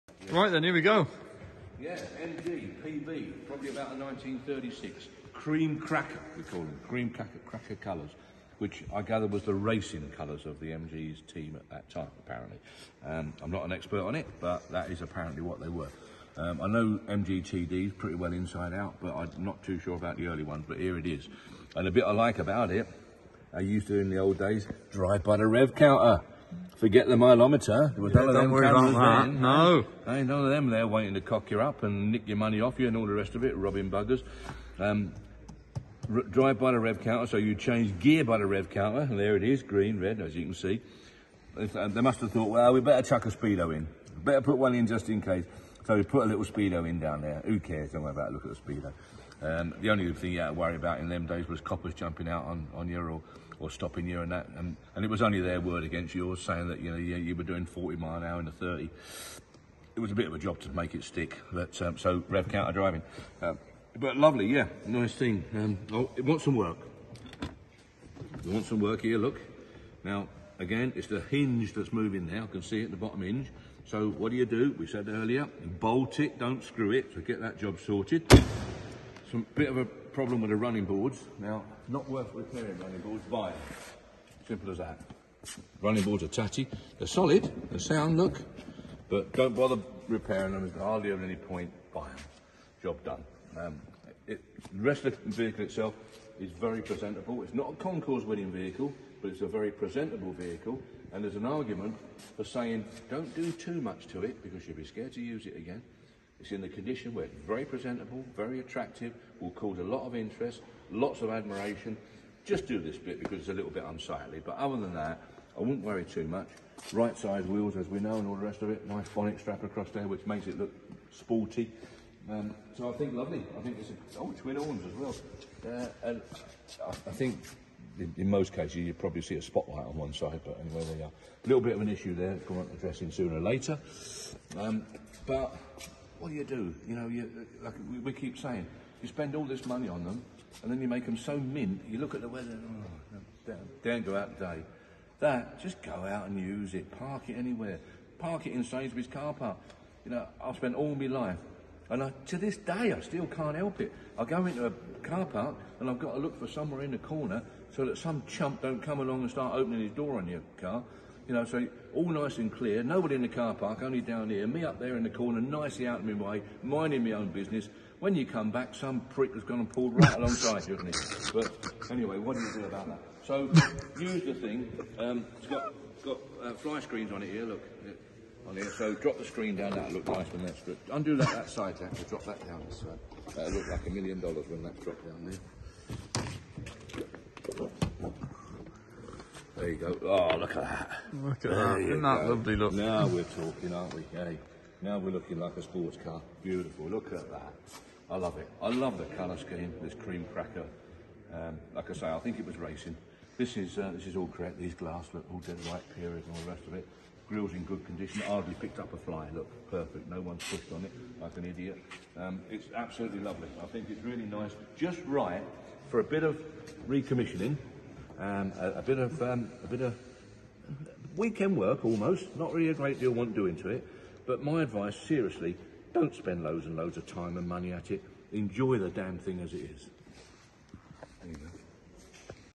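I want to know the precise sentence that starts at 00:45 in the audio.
So we put a little speedo in down there.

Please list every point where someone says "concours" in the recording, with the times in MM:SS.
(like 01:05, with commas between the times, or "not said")
01:37.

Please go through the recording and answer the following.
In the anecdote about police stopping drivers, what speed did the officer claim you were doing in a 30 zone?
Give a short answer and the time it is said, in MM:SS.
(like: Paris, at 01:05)
40 mph, at 00:57.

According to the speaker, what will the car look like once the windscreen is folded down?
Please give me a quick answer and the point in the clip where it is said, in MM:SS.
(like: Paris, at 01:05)
A million dollars, at 03:03.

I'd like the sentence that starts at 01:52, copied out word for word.
Just do this bit because it's a little bit unsightly, but other than that, I wouldn't worry too much.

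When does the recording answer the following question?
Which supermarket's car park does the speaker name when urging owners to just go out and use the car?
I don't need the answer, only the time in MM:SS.
02:28.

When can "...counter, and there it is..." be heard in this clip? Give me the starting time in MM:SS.
00:38.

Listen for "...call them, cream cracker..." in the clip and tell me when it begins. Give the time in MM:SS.
00:06.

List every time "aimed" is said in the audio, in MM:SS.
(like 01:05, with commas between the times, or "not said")
not said.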